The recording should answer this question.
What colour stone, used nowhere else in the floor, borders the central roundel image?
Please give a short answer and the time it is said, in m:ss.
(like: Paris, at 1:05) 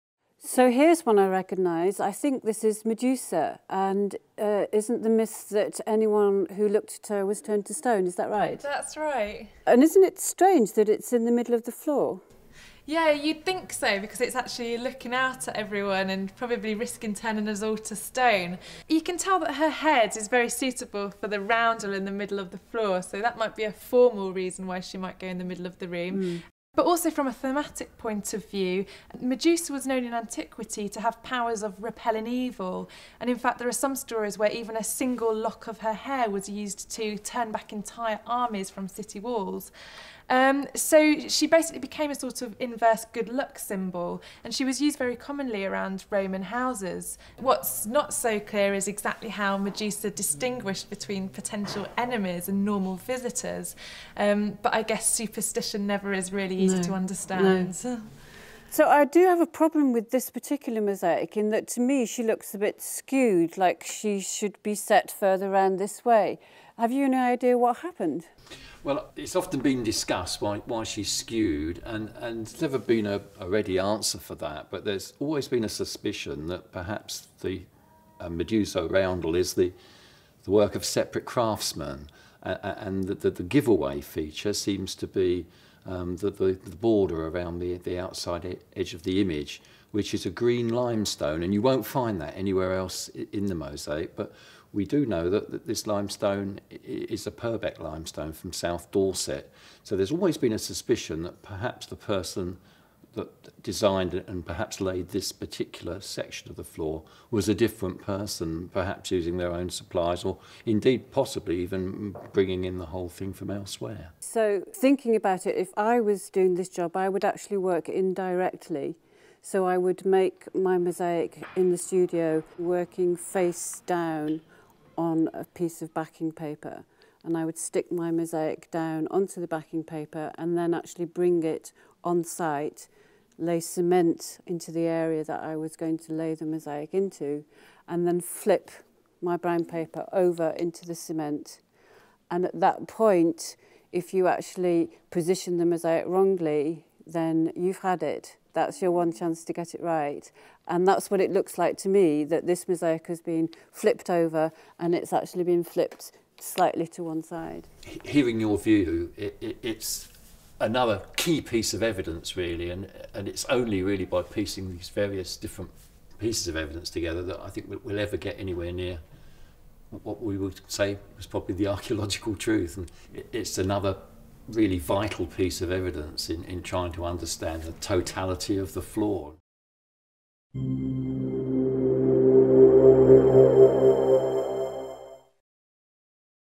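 Green, at 1:30.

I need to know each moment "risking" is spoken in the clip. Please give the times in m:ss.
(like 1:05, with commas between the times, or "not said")
0:16.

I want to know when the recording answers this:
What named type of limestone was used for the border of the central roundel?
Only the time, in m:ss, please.
1:37.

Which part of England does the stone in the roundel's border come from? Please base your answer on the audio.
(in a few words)
South Dorset.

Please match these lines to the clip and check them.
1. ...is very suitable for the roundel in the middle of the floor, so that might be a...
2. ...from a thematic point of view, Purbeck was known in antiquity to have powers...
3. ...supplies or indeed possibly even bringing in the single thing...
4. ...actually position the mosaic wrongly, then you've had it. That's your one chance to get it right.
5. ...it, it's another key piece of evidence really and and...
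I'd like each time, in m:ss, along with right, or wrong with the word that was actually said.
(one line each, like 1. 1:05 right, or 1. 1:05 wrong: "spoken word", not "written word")
1. 0:20 right
2. 0:27 wrong: "Medusa", not "Purbeck"
3. 1:49 wrong: "whole", not "single"
4. 2:24 right
5. 2:39 right.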